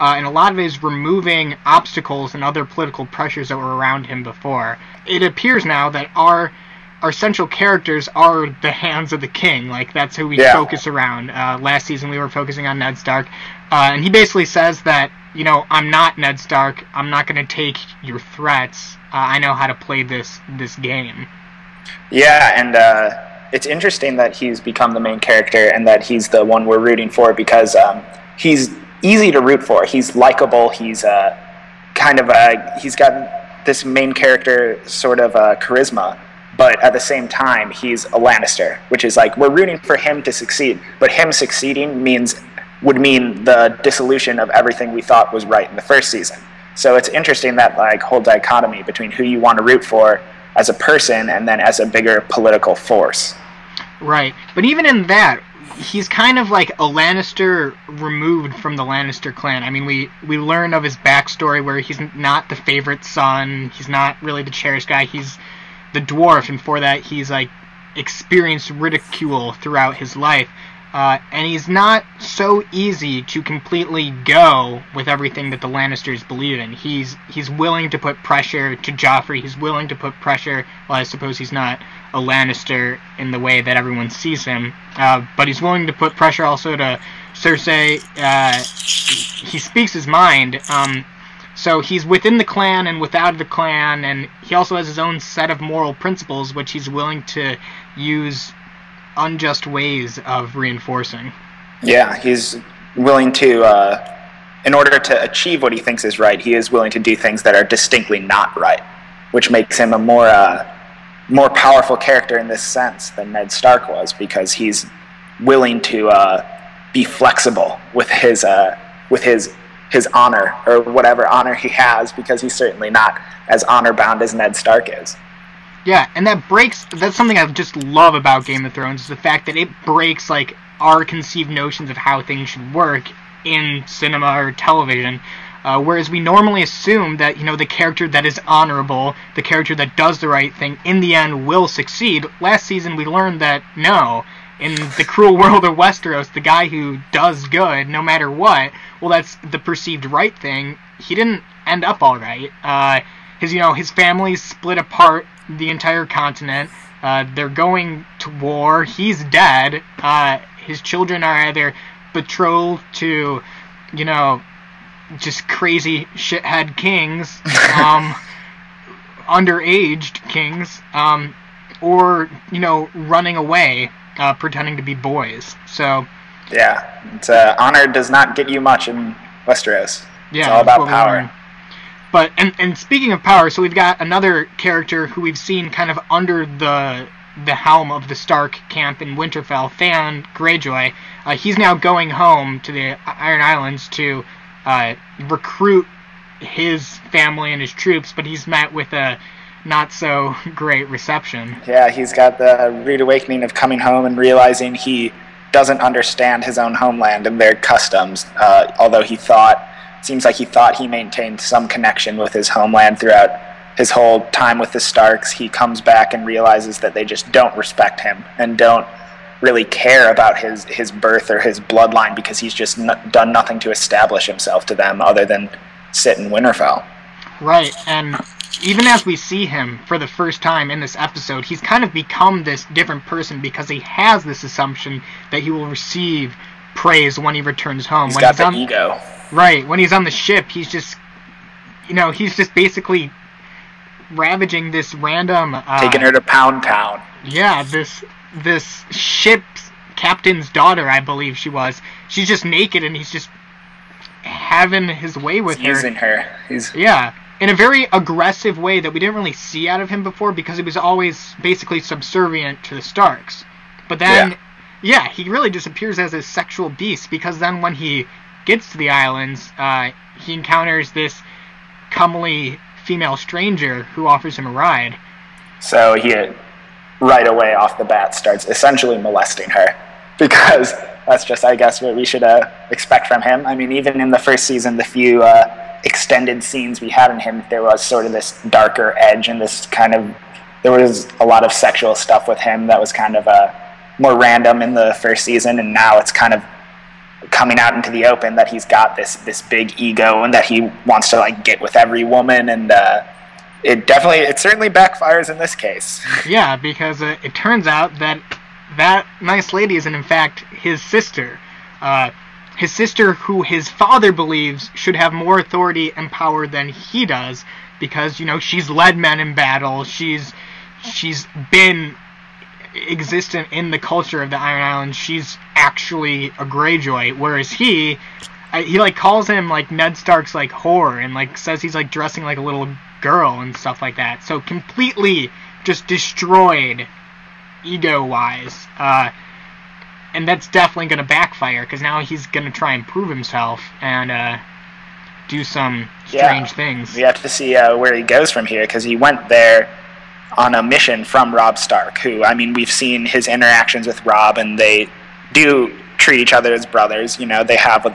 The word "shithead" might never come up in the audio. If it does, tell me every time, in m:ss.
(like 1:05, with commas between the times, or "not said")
2:46.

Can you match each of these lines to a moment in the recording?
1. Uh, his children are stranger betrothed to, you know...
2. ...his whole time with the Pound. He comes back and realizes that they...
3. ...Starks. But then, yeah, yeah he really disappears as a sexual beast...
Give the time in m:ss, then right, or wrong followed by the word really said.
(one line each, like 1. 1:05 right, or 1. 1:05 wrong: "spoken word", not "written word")
1. 2:39 wrong: "either", not "stranger"
2. 3:33 wrong: "Starks", not "Pound"
3. 4:22 right.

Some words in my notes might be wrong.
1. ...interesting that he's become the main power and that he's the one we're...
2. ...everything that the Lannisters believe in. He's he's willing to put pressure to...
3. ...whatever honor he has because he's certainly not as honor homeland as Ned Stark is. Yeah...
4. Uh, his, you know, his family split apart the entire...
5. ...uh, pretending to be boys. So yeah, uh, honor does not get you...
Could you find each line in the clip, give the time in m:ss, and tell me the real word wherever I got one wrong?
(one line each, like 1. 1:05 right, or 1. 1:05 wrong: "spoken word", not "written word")
1. 0:23 wrong: "character", not "power"
2. 1:15 right
3. 2:00 wrong: "bound", not "homeland"
4. 2:32 right
5. 2:54 right.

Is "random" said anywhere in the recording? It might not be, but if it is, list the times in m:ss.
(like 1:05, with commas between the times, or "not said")
4:04, 4:54.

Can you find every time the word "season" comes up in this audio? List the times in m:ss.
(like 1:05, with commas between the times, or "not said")
0:11, 0:46, 2:22, 4:44, 4:55.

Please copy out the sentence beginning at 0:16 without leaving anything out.
I'm not going to take your threats.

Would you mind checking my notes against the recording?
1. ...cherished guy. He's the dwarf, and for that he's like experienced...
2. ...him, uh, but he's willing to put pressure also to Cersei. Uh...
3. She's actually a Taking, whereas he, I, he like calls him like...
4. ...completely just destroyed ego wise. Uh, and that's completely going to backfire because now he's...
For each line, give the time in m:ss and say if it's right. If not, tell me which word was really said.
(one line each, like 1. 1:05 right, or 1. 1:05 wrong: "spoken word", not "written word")
1. 1:04 right
2. 1:24 right
3. 5:24 wrong: "Greyjoy", not "Taking"
4. 5:34 wrong: "definitely", not "completely".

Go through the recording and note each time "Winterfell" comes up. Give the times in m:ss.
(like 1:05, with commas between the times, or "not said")
3:09, 3:46.